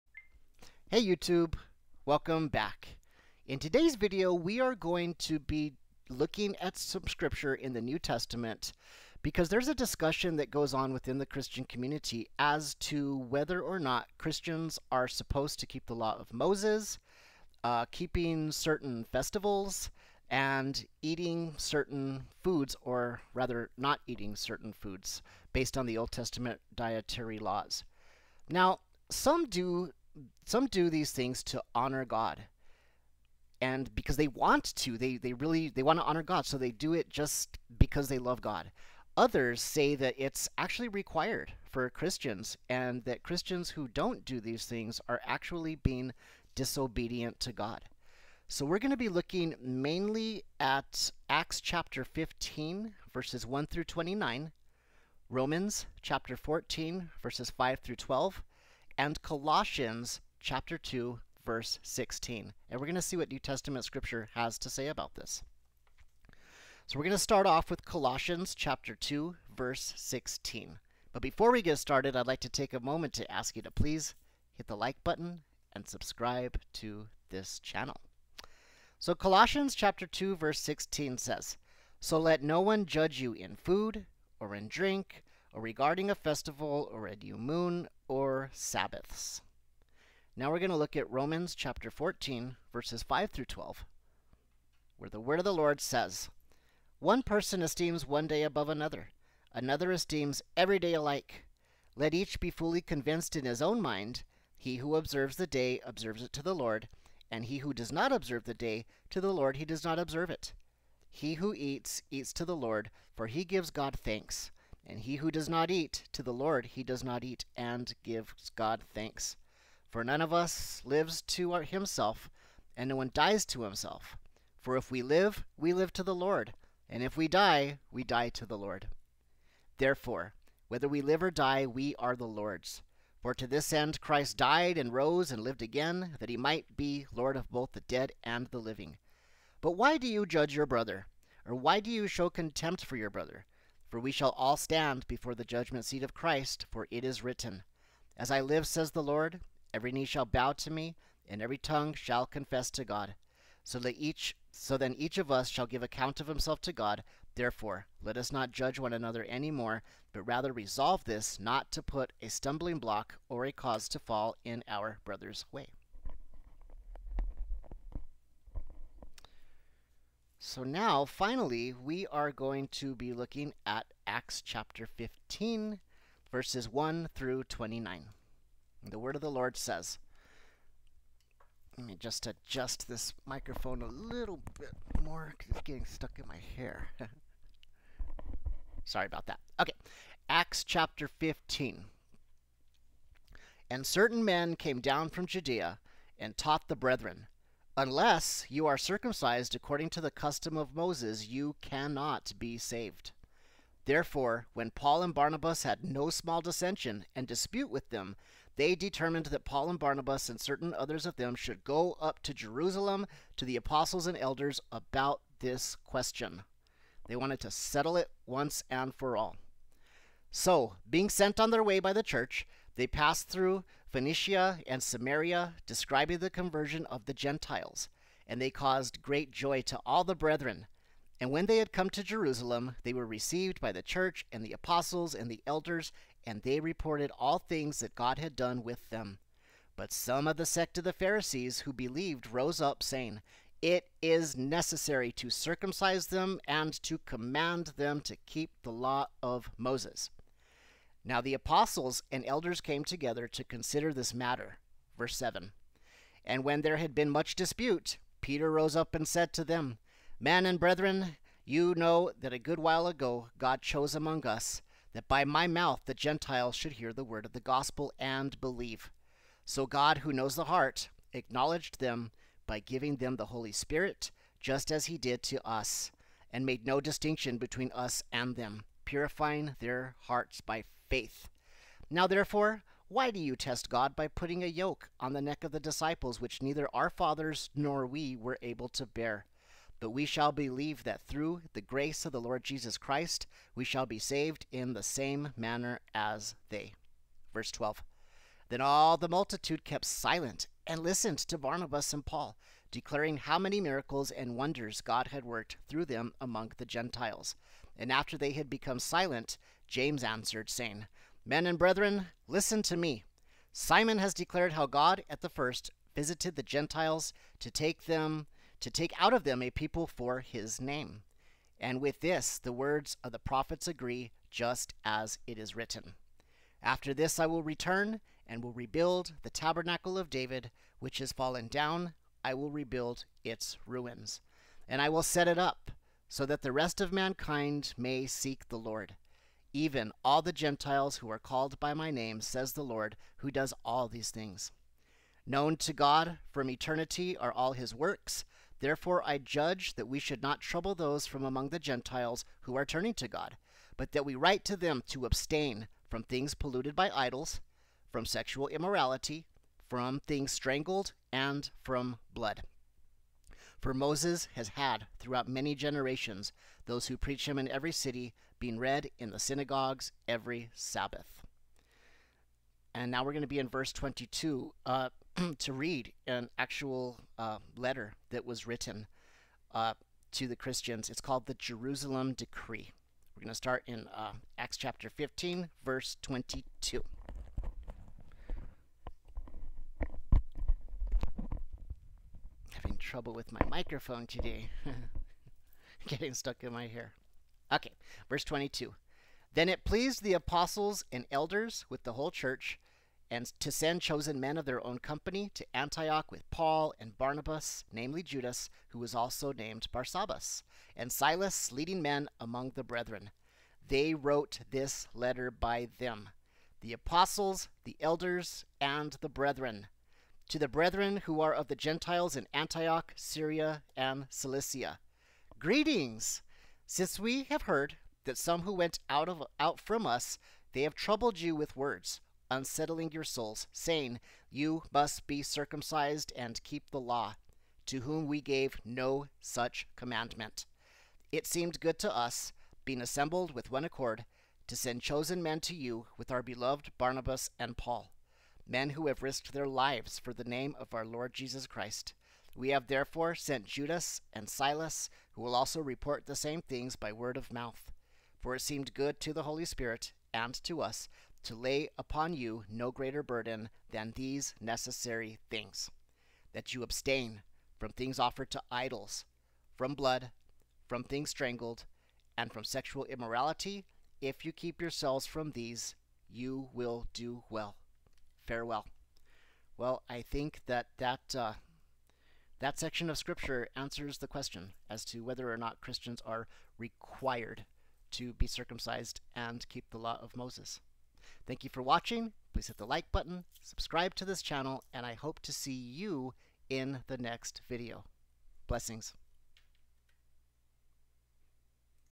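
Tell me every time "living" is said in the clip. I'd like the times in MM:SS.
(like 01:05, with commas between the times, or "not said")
02:18.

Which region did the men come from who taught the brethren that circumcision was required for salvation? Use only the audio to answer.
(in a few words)
Judea.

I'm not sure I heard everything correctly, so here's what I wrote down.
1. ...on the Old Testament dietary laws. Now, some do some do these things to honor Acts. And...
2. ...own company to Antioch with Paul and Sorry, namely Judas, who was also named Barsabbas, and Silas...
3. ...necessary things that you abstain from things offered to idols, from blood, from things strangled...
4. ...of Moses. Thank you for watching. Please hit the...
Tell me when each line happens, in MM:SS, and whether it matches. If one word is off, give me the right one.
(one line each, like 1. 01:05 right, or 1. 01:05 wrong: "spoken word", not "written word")
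1. 00:25 wrong: "God", not "Acts"
2. 06:44 wrong: "Barnabas", not "Sorry"
3. 07:44 right
4. 08:10 right.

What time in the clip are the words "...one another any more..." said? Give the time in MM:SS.
02:38.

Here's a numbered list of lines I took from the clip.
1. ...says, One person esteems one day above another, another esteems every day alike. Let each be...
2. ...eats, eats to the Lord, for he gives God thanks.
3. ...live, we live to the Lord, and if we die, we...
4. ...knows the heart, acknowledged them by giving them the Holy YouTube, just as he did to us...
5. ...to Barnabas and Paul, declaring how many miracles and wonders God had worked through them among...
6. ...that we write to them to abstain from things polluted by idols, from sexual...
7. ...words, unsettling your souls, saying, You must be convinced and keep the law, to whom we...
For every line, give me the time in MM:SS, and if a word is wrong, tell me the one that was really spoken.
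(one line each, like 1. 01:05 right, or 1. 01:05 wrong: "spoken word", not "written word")
1. 01:35 right
2. 01:51 right
3. 02:05 right
4. 04:30 wrong: "Spirit", not "YouTube"
5. 05:01 right
6. 05:53 right
7. 07:11 wrong: "circumcised", not "convinced".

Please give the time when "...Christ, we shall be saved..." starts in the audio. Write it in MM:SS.
04:52.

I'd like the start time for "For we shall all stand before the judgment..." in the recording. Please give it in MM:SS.
02:23.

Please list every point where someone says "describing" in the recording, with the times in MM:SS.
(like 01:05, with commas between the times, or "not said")
03:45.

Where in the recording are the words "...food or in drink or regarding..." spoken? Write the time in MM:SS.
01:23.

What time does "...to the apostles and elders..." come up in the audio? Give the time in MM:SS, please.
03:33.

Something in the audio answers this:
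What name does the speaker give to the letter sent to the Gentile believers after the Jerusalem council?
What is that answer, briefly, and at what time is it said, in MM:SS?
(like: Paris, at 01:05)
Jerusalem Decree, at 06:21.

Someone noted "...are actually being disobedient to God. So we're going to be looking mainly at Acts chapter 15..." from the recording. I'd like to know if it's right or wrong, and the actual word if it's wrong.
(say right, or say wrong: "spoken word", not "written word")
right.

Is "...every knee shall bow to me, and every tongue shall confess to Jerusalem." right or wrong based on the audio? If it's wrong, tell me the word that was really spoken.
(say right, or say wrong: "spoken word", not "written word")
wrong: "God", not "Jerusalem".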